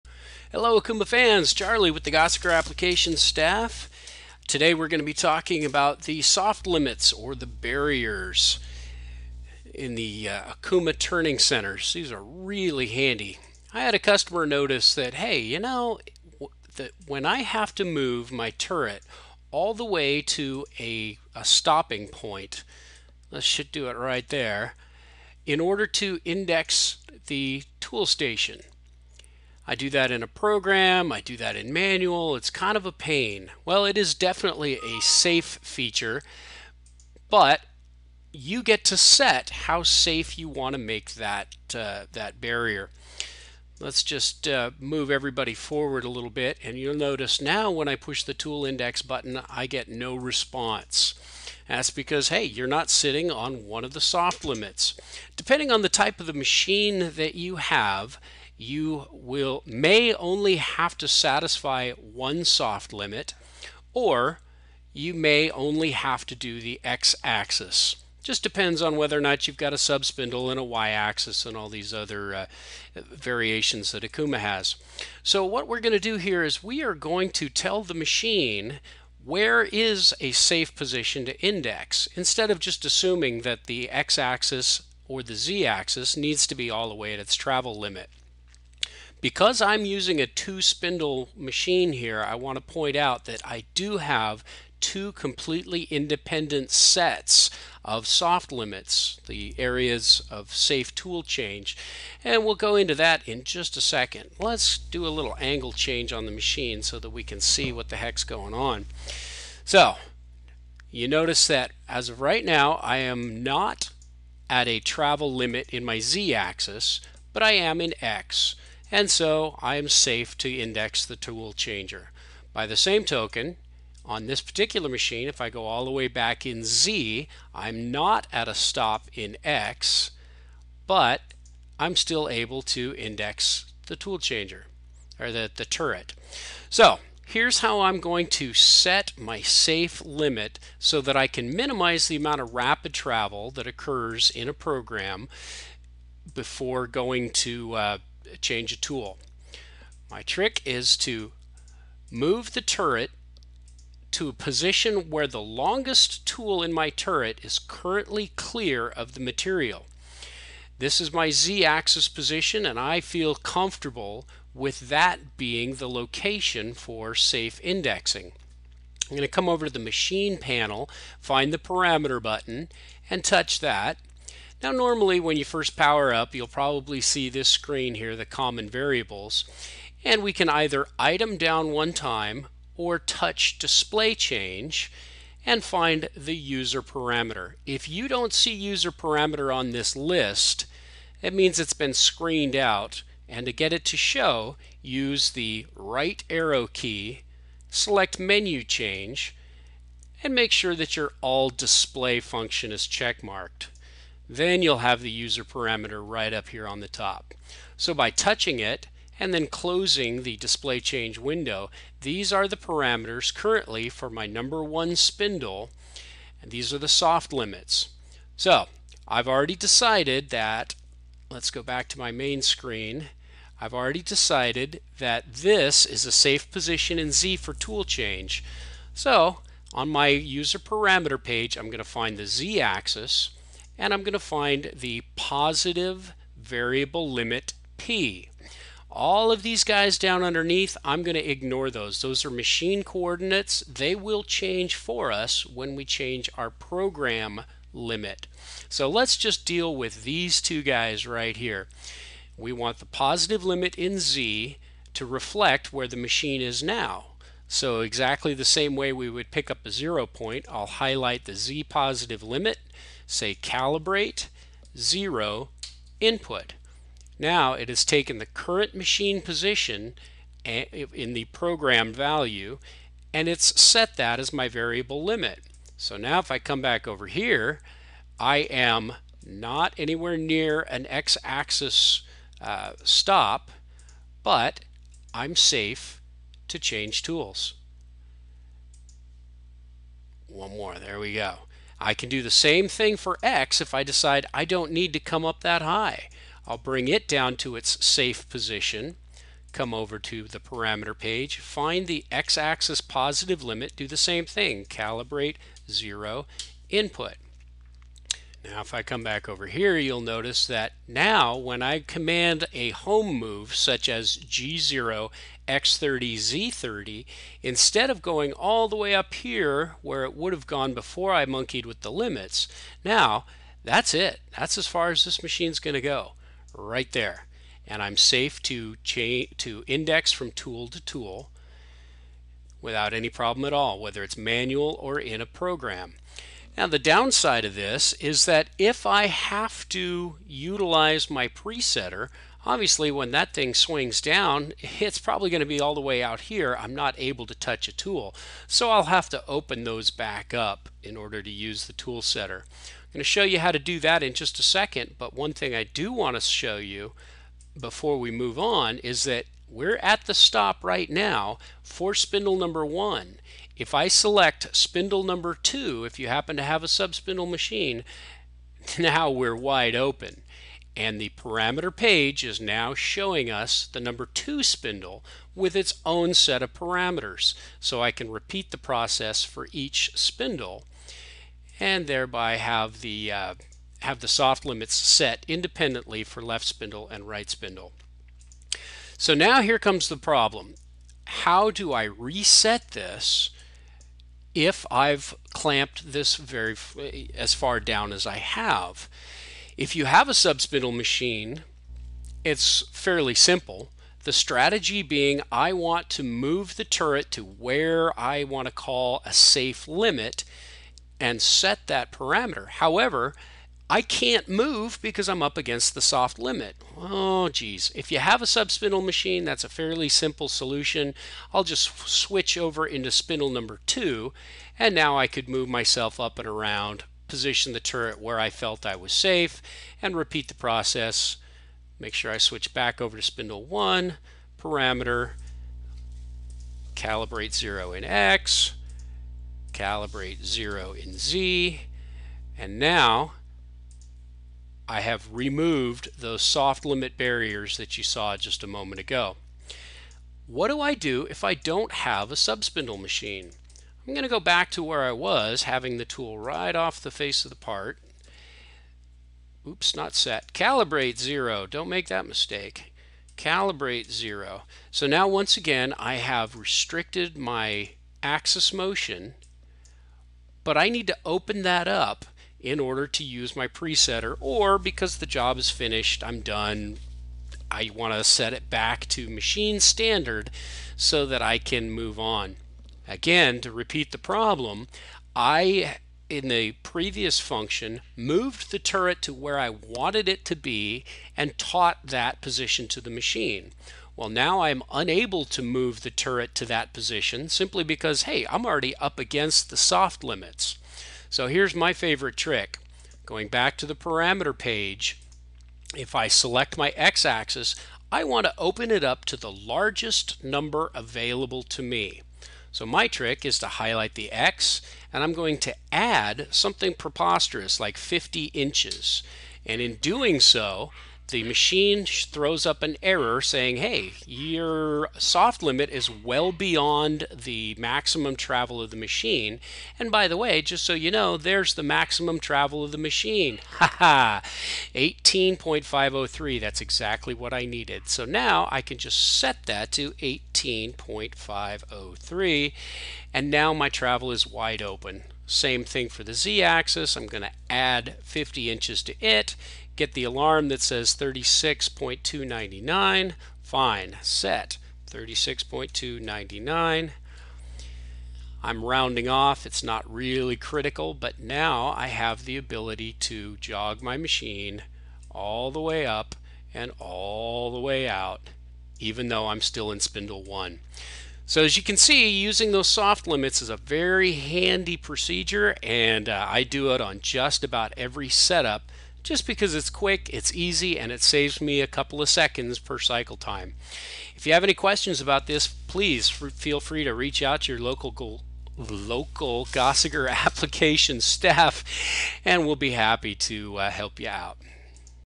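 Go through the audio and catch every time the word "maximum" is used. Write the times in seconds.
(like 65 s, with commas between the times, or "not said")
527 s, 531 s.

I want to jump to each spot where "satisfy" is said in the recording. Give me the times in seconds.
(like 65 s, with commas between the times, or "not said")
61 s.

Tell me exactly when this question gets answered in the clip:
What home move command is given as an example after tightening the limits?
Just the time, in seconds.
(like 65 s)
314 s.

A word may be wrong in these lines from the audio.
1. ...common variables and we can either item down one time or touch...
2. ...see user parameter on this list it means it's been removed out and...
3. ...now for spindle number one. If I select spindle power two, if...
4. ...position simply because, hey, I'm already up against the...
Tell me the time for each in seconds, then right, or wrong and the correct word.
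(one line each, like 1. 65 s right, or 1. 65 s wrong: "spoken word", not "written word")
1. 178 s right
2. 188 s wrong: "screened", not "removed"
3. 360 s wrong: "number", not "power"
4. 496 s right.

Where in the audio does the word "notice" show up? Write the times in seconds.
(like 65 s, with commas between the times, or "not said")
14 s, 46 s, 111 s, 310 s.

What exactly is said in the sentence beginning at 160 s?
This is my z-axis position and I feel comfortable with that being the location for safe indexing.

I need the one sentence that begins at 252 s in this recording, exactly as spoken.
We want the positive limit in z to reflect where the machine is now.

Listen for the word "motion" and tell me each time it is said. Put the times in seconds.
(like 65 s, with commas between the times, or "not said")
468 s.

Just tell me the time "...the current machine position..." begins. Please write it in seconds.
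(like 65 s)
268 s.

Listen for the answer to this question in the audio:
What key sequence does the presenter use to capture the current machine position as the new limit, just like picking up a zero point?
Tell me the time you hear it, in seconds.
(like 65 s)
263 s.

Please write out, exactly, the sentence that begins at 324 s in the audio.
That's as far as this machine's going to go, right there.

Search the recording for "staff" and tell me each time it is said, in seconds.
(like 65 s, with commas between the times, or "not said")
3 s, 591 s.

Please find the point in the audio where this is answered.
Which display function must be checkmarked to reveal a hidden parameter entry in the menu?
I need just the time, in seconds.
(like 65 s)
201 s.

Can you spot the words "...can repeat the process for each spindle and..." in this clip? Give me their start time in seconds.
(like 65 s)
377 s.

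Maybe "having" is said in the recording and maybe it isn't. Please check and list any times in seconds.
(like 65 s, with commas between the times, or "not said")
455 s.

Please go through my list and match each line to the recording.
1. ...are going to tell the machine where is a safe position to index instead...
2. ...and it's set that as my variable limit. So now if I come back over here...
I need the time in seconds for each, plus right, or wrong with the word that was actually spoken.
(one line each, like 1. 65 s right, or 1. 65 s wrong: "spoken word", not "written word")
1. 76 s right
2. 273 s right.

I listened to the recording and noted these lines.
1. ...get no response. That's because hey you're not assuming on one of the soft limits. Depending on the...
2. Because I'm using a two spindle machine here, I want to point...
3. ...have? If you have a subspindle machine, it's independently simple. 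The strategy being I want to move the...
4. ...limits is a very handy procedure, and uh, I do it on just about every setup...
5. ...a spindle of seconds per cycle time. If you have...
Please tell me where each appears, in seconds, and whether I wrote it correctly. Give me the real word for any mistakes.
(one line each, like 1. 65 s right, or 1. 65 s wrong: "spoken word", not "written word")
1. 49 s wrong: "sitting", not "assuming"
2. 89 s right
3. 398 s wrong: "fairly", not "independently"
4. 573 s right
5. 581 s wrong: "couple", not "spindle".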